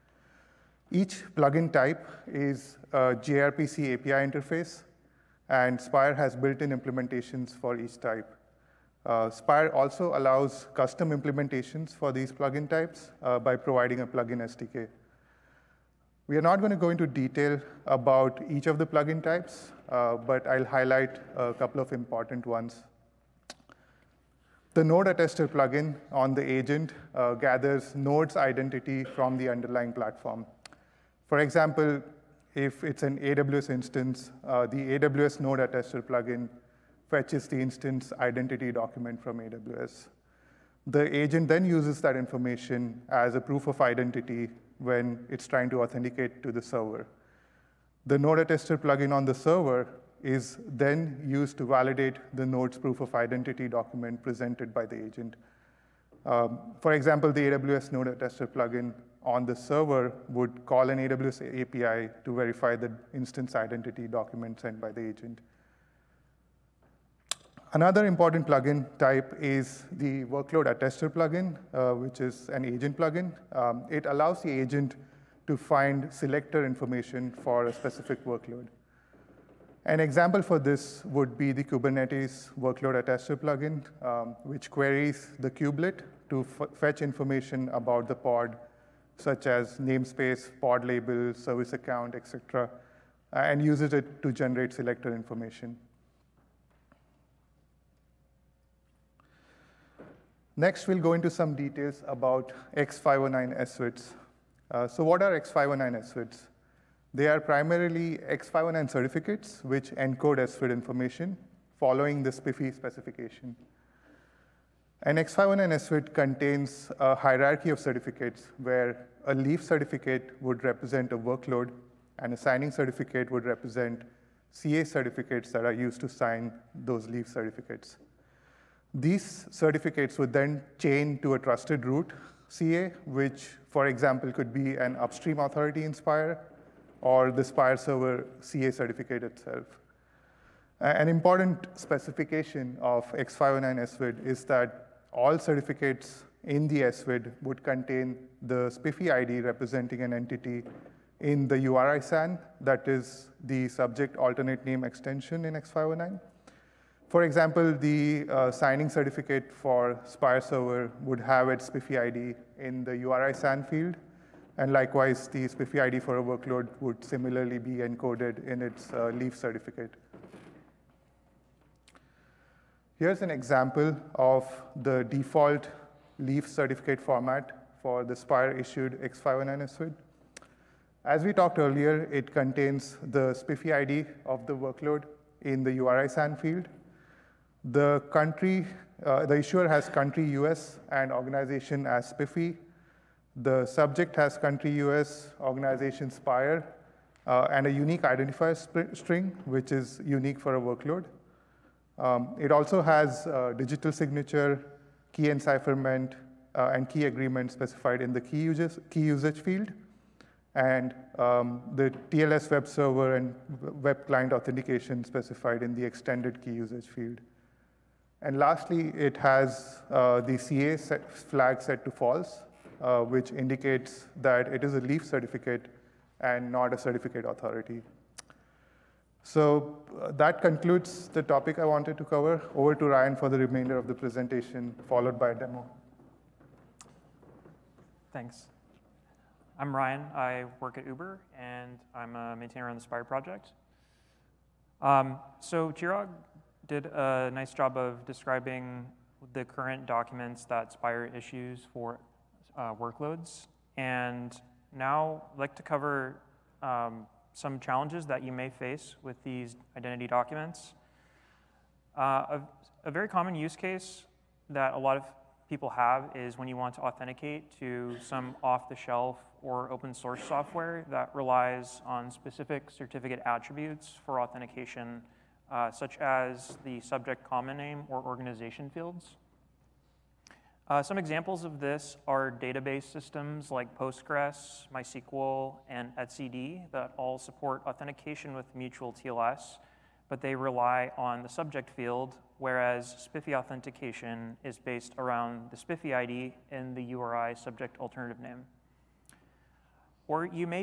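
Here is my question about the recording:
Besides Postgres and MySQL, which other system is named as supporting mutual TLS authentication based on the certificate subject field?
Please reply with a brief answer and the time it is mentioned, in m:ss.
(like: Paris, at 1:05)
etcd, at 4:45.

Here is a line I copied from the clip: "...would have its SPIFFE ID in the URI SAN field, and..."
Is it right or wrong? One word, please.
right.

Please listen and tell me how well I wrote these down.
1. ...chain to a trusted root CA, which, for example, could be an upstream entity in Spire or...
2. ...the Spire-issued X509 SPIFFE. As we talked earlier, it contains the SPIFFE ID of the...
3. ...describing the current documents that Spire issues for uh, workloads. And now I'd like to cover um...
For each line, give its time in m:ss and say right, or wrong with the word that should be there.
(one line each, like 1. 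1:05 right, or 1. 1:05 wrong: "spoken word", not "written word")
1. 2:10 wrong: "authority", not "entity"
2. 2:58 wrong: "SVID", not "SPIFFE"
3. 4:08 right.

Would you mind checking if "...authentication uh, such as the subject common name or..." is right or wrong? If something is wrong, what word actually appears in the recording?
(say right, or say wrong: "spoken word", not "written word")
right.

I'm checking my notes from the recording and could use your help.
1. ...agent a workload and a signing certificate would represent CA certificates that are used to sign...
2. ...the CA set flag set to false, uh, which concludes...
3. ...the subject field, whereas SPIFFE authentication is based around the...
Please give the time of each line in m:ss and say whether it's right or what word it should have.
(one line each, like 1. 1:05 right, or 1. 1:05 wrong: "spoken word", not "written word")
1. 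2:00 wrong: "represent", not "agent"
2. 3:40 wrong: "indicates", not "concludes"
3. 4:51 right.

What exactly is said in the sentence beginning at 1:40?
Next, we'll go into some details about X509 SVIDs.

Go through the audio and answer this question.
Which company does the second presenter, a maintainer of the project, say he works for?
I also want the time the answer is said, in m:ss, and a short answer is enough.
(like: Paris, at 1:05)
Uber, at 4:00.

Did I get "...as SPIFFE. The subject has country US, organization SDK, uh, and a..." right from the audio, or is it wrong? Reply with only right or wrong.
wrong.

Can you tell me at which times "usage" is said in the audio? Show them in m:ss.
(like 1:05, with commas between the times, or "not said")
3:28, 3:36.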